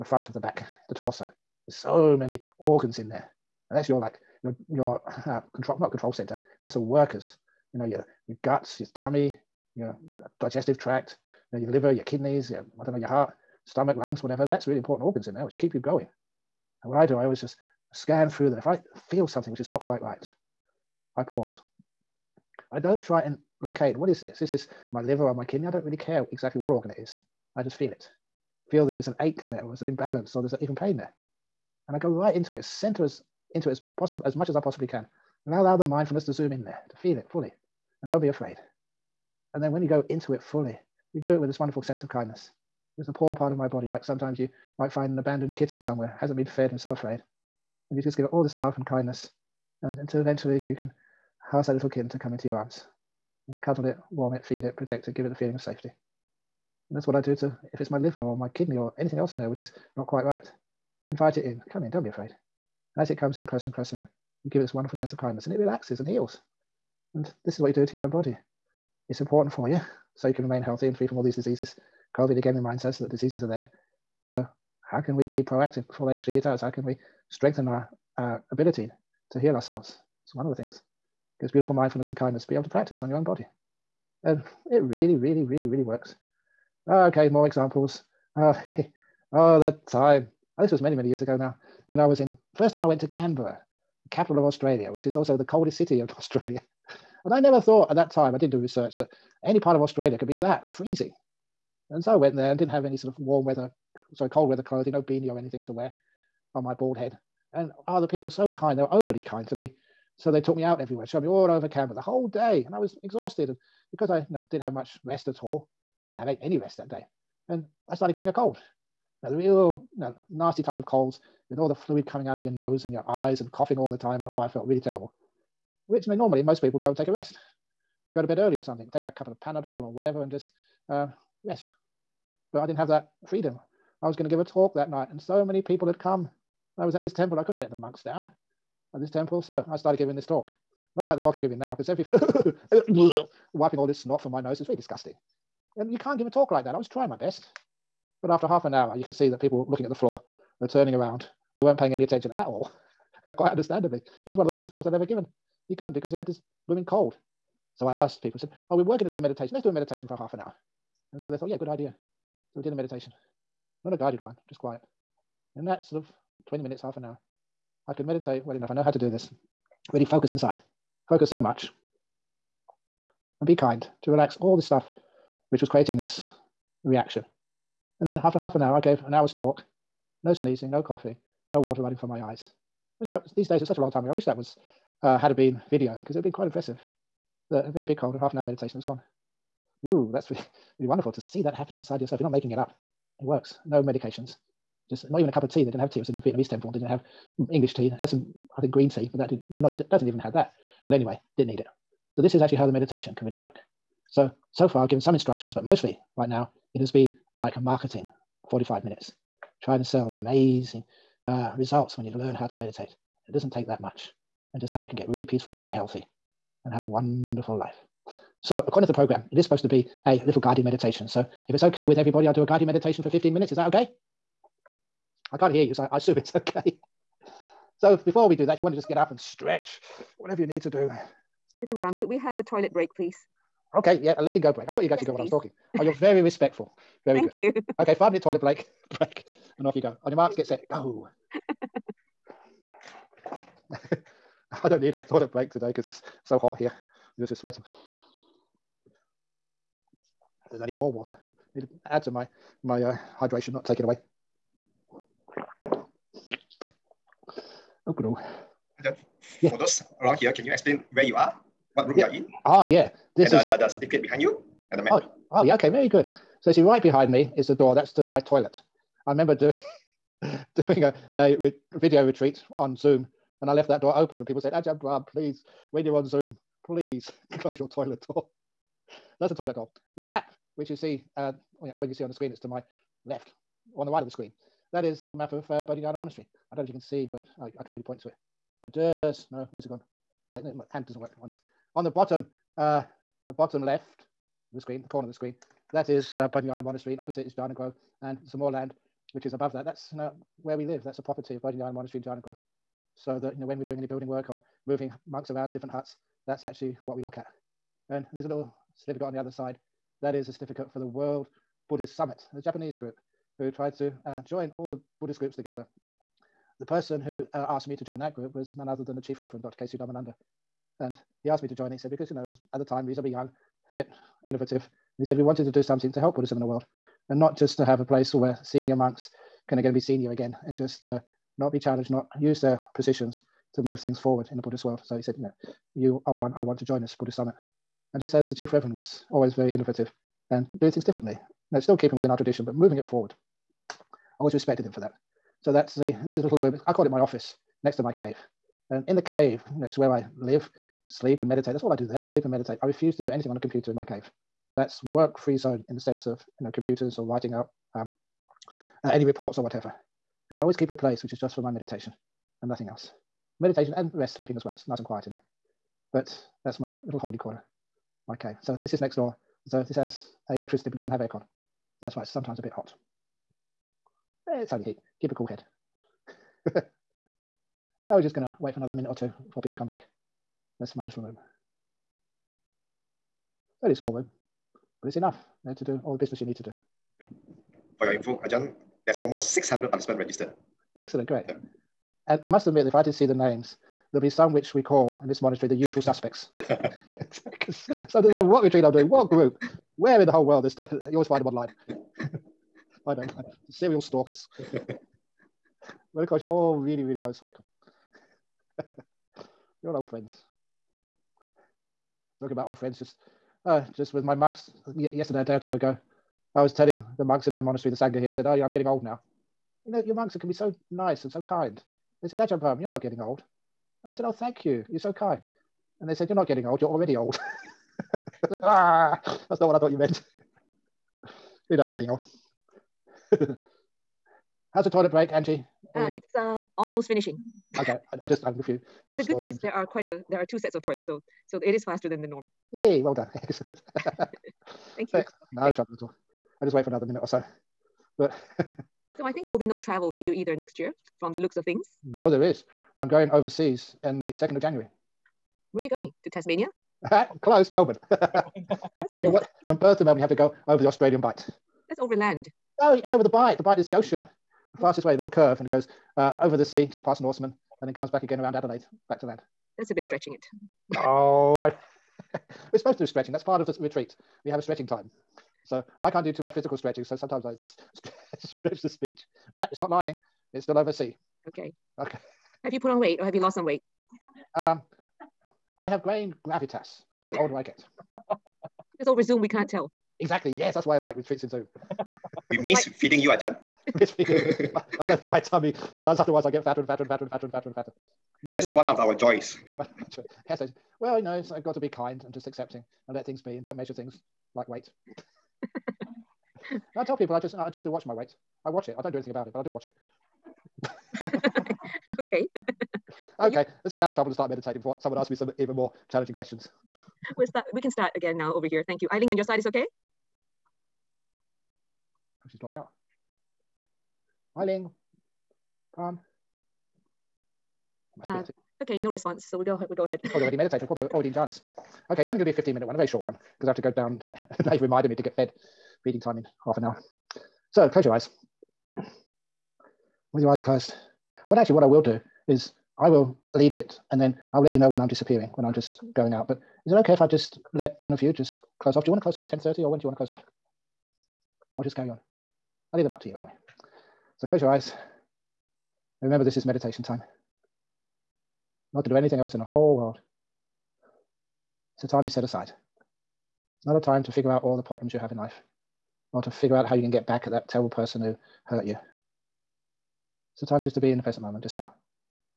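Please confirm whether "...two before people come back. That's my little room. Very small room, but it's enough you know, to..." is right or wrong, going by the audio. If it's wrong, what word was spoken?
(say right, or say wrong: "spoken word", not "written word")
right.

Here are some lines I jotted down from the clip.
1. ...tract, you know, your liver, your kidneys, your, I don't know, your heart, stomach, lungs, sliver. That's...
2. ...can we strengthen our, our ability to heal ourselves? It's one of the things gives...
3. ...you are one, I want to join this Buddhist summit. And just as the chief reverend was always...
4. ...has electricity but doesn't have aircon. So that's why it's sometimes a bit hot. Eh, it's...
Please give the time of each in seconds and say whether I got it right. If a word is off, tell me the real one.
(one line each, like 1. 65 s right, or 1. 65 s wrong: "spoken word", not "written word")
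1. 10 s wrong: "whatever", not "sliver"
2. 76 s right
3. 335 s right
4. 369 s right.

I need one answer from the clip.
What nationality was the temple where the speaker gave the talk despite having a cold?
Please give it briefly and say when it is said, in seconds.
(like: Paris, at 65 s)
Vietnamese, at 196 s.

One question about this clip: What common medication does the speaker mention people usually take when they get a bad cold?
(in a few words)
Panadol.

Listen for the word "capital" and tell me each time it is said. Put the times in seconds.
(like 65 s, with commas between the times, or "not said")
94 s.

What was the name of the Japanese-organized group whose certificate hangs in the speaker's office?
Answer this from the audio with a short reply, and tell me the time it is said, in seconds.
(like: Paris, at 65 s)
World Buddhist Summit, at 310 s.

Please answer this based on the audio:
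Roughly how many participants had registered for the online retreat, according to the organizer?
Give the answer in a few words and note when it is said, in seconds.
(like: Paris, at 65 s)
600, at 389 s.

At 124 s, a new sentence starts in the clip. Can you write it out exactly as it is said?
And oh, I felt really terrible.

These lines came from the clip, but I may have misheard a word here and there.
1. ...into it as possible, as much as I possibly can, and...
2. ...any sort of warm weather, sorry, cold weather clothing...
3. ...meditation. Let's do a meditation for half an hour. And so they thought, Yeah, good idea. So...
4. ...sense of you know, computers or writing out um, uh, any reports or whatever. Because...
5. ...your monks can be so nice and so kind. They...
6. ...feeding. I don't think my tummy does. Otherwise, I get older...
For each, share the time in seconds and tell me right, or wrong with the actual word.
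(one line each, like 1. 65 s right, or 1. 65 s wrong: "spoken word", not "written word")
1. 33 s right
2. 102 s right
3. 159 s right
4. 355 s right
5. 419 s right
6. 493 s wrong: "fatter", not "older".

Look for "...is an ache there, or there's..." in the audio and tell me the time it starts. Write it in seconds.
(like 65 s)
28 s.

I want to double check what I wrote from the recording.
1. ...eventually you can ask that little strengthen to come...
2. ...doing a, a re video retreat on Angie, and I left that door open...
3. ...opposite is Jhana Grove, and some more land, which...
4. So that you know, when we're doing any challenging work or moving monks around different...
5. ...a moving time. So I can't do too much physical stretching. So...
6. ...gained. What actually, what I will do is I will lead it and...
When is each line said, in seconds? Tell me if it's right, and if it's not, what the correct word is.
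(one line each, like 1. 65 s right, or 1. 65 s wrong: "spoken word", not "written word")
1. 50 s wrong: "kitten", not "strengthen"
2. 270 s wrong: "Zoom", not "Angie"
3. 296 s right
4. 302 s wrong: "building", not "challenging"
5. 474 s wrong: "stretching", not "moving"
6. 540 s wrong: "closed", not "gained".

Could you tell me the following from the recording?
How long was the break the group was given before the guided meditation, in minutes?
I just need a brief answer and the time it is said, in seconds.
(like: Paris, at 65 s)
5, at 237 s.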